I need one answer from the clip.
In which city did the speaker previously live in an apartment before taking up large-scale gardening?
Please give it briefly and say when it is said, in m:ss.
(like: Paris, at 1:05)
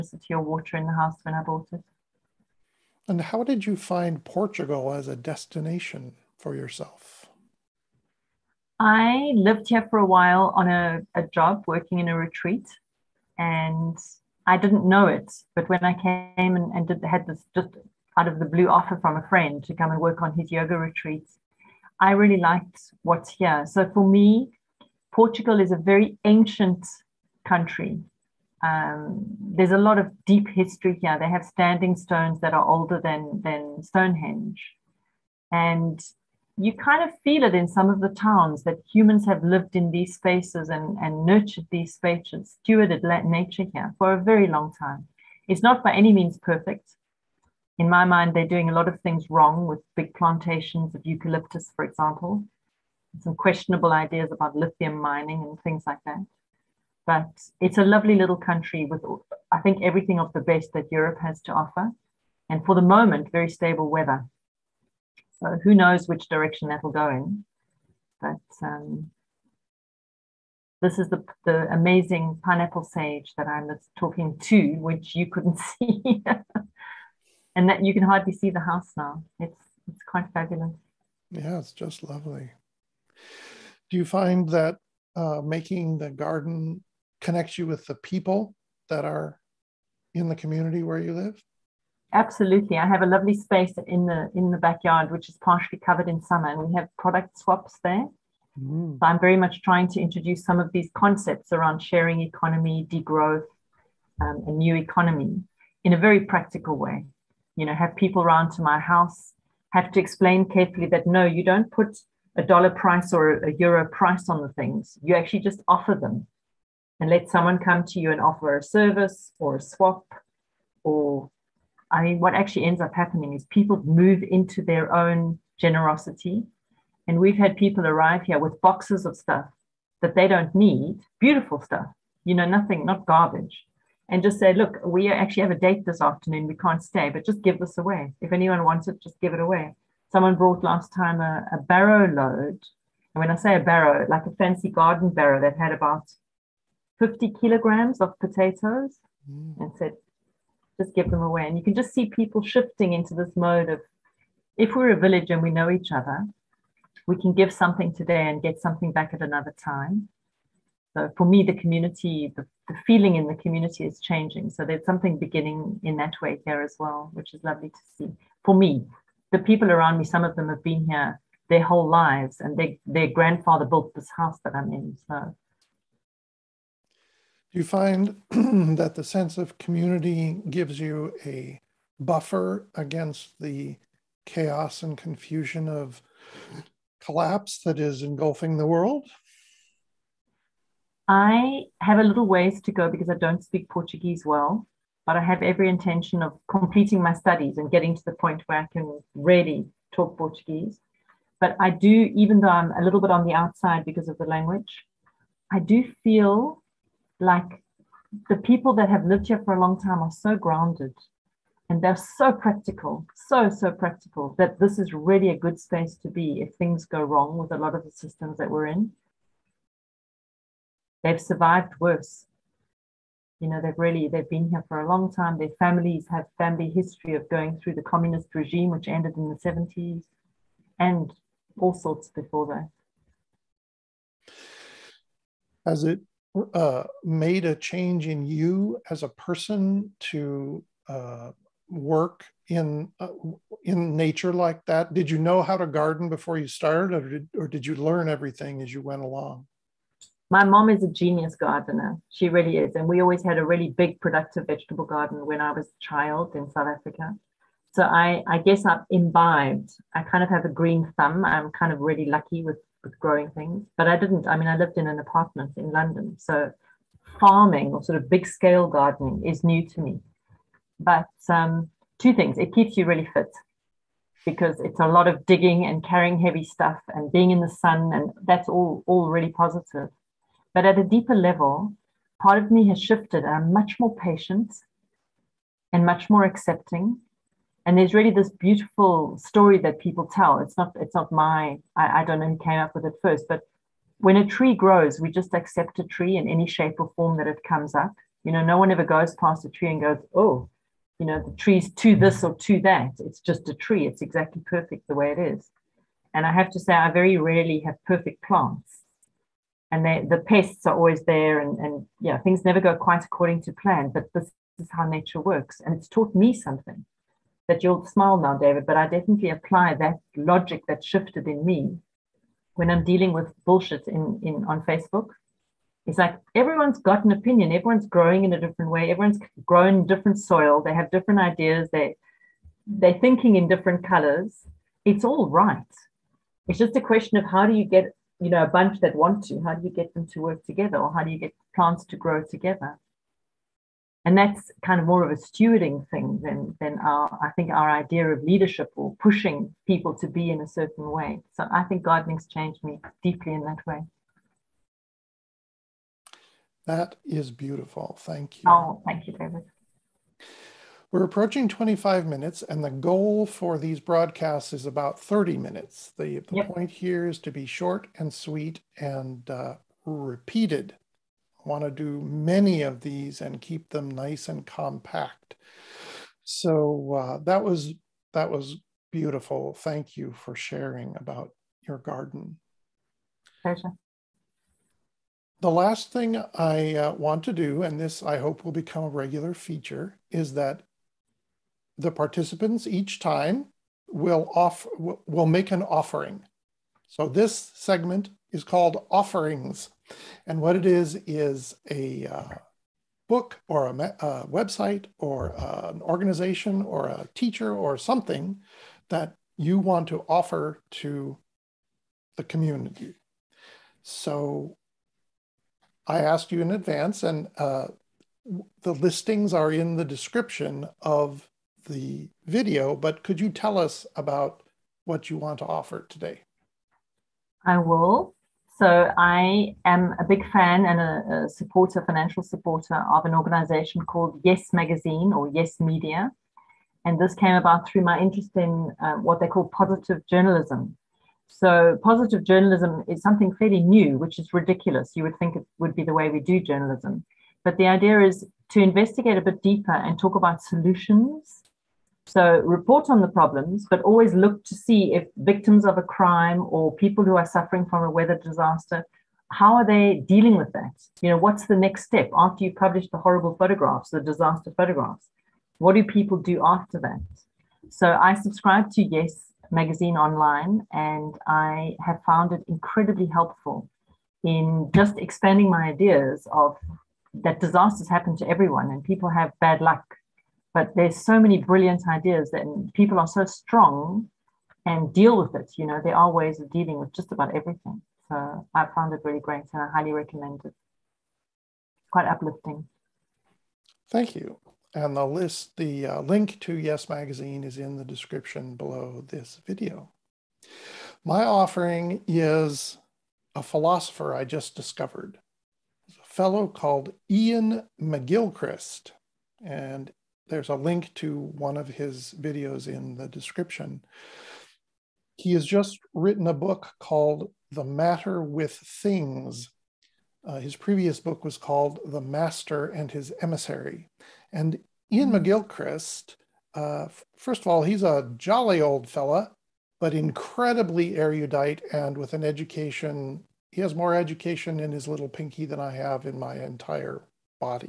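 London, at 4:25.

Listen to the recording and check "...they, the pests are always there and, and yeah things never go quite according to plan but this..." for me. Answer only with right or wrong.
right.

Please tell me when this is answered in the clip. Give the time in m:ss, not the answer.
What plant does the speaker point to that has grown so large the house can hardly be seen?
1:12.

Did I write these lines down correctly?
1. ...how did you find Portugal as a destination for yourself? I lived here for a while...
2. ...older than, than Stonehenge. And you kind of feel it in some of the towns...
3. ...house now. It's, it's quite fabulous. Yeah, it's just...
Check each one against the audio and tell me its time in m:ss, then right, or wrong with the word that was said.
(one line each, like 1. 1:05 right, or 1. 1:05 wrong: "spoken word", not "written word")
1. 0:03 right
2. 0:32 right
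3. 1:18 right.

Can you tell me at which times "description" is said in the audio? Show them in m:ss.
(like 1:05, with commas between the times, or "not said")
6:59, 8:17, 8:33.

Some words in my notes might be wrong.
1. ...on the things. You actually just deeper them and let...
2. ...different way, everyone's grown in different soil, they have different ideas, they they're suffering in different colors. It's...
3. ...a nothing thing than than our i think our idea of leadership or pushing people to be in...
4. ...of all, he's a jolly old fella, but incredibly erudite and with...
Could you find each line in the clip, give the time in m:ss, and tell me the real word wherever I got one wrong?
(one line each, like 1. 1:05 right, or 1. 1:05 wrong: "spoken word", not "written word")
1. 1:54 wrong: "offer", not "deeper"
2. 5:28 wrong: "thinking", not "suffering"
3. 5:45 wrong: "stewarding", not "nothing"
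4. 8:47 right.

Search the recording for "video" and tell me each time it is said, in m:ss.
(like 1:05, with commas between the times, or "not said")
7:02, 8:19, 8:32.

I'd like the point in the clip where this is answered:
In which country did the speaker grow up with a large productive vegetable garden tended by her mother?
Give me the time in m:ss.
4:16.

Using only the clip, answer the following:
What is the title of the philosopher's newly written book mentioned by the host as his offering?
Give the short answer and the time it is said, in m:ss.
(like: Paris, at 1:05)
The Matter with Things, at 8:37.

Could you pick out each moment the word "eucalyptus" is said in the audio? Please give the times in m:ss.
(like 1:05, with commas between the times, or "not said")
0:51.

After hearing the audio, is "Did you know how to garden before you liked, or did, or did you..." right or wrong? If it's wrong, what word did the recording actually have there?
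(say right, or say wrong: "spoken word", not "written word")
wrong: "started", not "liked".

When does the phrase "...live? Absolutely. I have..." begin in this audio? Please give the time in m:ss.
1:31.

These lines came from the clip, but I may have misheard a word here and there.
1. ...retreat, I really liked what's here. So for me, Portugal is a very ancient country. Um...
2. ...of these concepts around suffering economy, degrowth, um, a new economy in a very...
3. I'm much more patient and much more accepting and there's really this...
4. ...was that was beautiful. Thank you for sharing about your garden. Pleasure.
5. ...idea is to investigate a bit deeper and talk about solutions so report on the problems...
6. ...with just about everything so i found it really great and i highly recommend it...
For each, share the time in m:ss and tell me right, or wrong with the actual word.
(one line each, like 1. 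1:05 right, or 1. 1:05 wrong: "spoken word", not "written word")
1. 0:20 right
2. 1:40 wrong: "sharing", not "suffering"
3. 4:43 right
4. 6:17 right
5. 7:27 right
6. 8:06 right.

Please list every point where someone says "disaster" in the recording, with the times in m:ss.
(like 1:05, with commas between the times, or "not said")
7:38, 7:44, 7:57.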